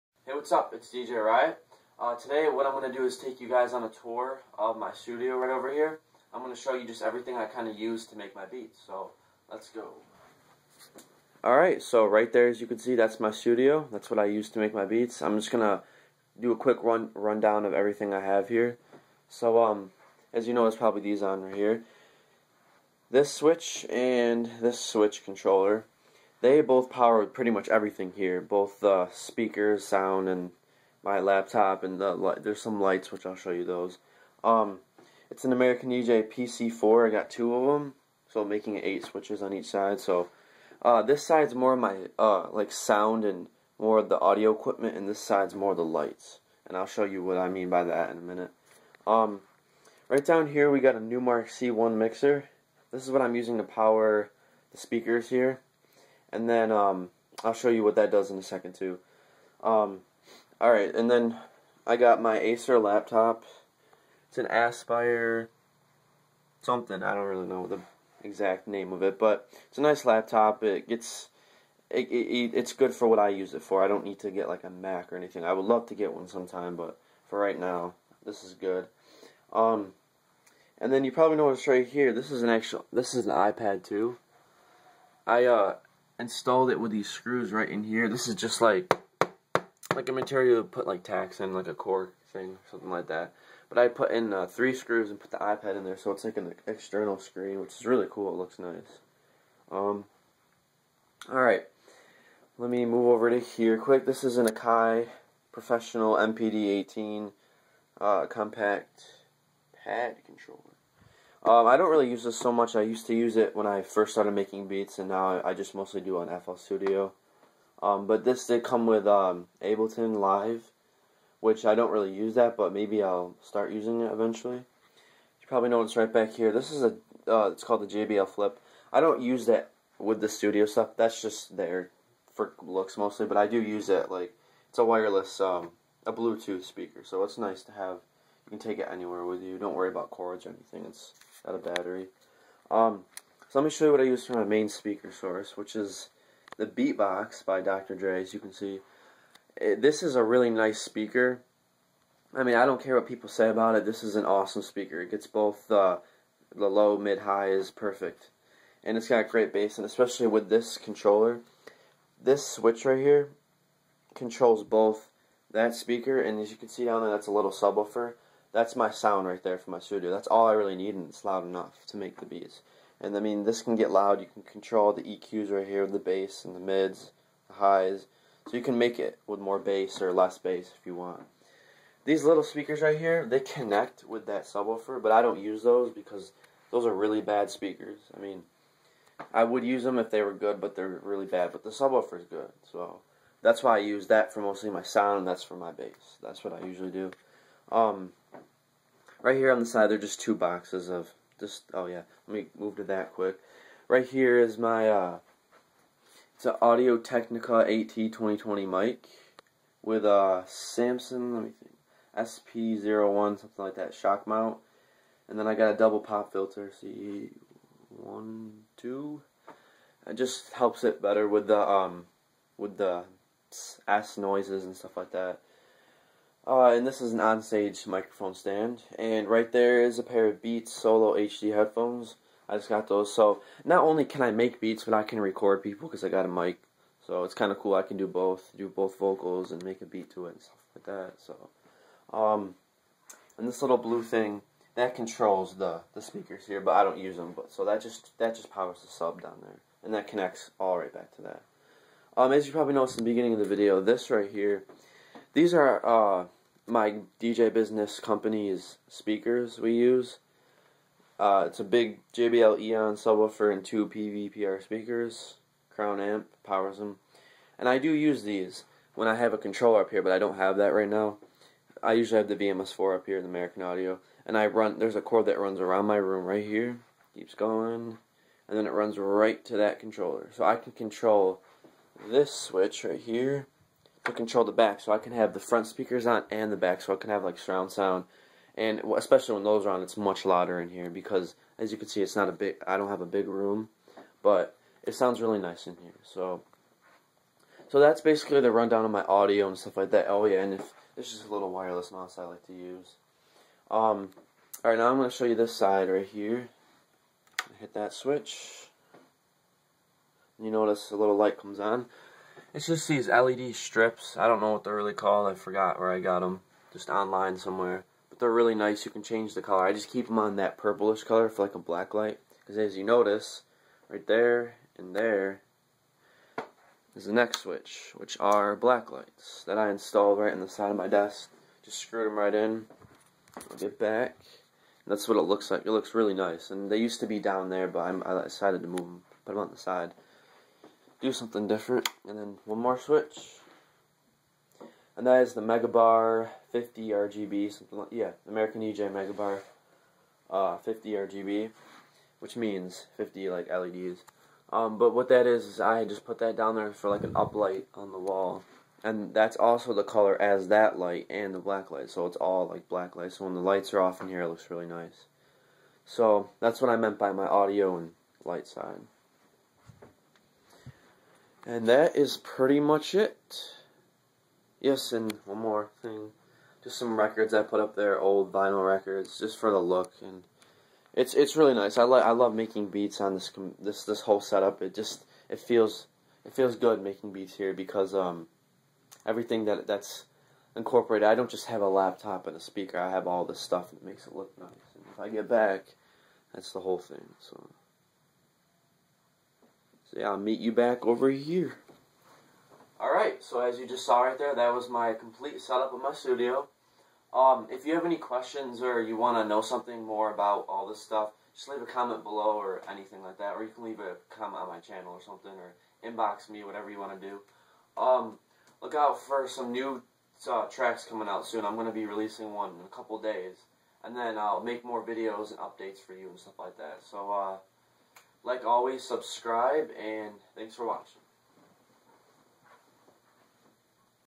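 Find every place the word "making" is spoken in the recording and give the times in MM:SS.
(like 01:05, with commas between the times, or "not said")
00:38, 01:54, 06:22, 06:26.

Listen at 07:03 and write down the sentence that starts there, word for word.
And then I'll make more videos and updates for you and stuff like that.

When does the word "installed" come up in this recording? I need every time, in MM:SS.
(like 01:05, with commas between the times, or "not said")
01:26, 05:29.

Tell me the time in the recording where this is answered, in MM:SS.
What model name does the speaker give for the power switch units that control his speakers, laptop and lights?
00:35.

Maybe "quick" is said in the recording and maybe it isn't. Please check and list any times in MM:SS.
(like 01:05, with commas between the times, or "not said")
00:16, 01:43, 03:23.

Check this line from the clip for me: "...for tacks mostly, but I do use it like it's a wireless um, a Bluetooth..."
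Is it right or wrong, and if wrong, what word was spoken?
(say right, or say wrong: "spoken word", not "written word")
wrong: "looks", not "tacks".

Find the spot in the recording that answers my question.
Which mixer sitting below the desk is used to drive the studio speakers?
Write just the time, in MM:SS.
00:50.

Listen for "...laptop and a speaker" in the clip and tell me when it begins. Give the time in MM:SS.
06:31.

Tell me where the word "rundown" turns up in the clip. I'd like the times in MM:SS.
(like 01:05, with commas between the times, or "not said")
00:17, 04:58.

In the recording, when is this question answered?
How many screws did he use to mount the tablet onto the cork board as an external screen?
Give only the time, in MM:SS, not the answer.
01:34.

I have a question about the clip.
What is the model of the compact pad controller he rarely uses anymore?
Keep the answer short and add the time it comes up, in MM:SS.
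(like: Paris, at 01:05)
Akai Professional MPD18, at 01:44.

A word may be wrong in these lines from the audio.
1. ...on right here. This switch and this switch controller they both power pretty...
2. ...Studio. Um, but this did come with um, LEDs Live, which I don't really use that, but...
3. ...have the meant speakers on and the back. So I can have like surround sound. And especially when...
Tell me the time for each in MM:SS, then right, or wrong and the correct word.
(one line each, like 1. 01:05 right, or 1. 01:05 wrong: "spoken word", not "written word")
1. 00:21 right
2. 01:56 wrong: "Ableton", not "LEDs"
3. 04:45 wrong: "front", not "meant".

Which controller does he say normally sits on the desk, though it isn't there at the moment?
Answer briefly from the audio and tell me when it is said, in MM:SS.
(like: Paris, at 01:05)
VMS4, at 04:32.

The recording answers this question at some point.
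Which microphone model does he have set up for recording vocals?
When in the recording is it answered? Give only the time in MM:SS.
03:26.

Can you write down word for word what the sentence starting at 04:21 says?
Uh, it's a big JBL Eon subwoofer and two PVPR speakers.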